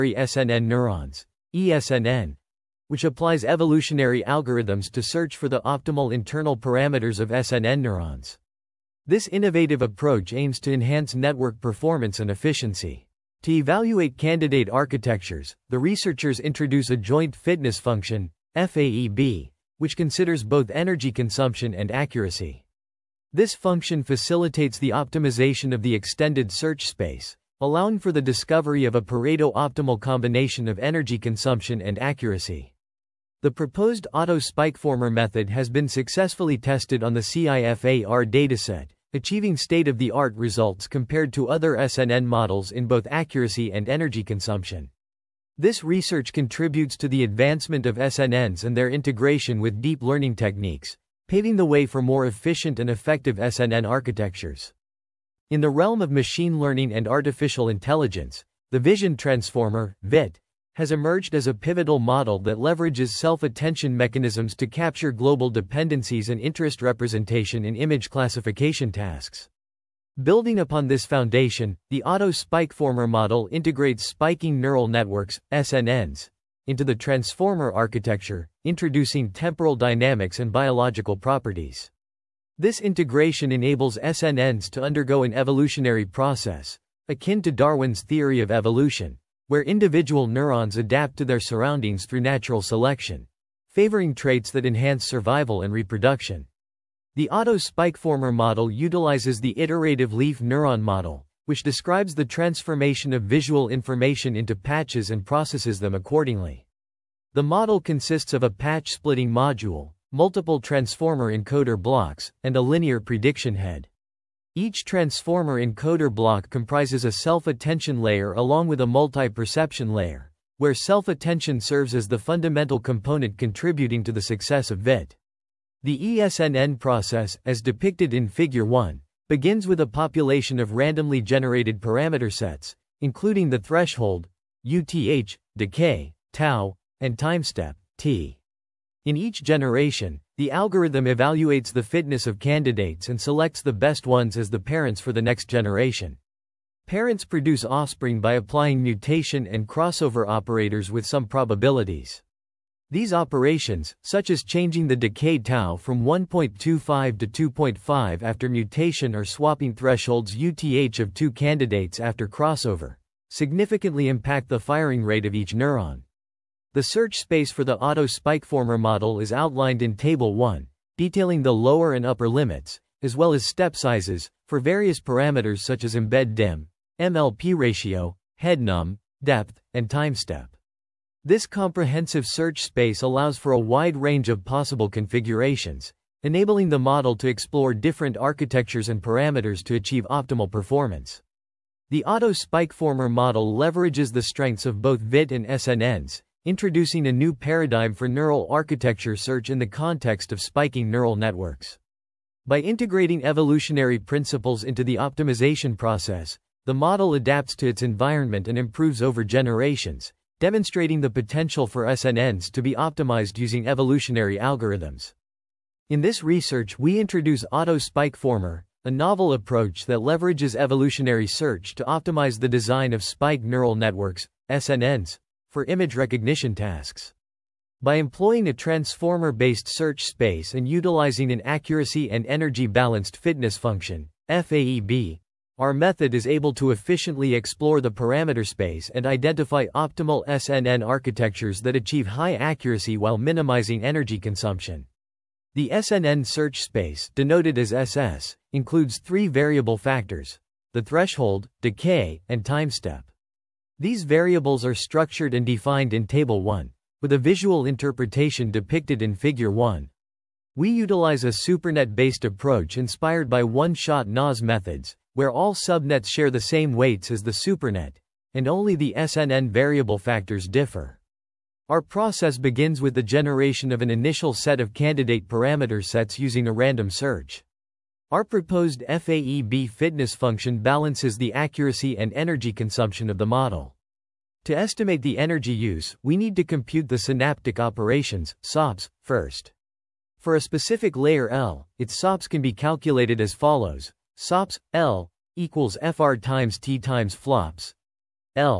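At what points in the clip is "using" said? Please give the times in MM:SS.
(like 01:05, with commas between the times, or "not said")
03:33, 04:36.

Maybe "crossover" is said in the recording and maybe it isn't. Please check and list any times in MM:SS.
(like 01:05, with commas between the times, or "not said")
02:29, 02:42.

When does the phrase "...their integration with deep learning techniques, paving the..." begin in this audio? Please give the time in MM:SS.
00:48.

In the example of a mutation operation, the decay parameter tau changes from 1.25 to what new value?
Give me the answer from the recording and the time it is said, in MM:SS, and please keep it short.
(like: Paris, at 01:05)
2.5, at 02:37.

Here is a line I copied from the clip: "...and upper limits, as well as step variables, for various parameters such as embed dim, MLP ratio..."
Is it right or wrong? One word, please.
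wrong.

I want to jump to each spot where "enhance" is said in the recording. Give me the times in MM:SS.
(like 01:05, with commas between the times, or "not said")
00:10, 01:34.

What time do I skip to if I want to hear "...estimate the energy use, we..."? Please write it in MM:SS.
04:44.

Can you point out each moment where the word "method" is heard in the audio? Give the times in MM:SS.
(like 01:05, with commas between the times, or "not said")
00:35, 03:55, 04:24.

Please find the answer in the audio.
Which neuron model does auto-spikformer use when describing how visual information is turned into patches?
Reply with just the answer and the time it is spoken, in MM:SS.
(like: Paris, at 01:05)
iterative LIF neuron model, at 01:39.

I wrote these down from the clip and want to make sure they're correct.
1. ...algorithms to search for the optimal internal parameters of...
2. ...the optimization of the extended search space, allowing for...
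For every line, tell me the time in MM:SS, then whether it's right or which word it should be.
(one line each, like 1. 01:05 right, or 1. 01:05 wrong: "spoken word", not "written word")
1. 00:04 right
2. 00:24 right.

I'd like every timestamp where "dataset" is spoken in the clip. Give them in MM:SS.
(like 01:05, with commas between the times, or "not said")
00:38.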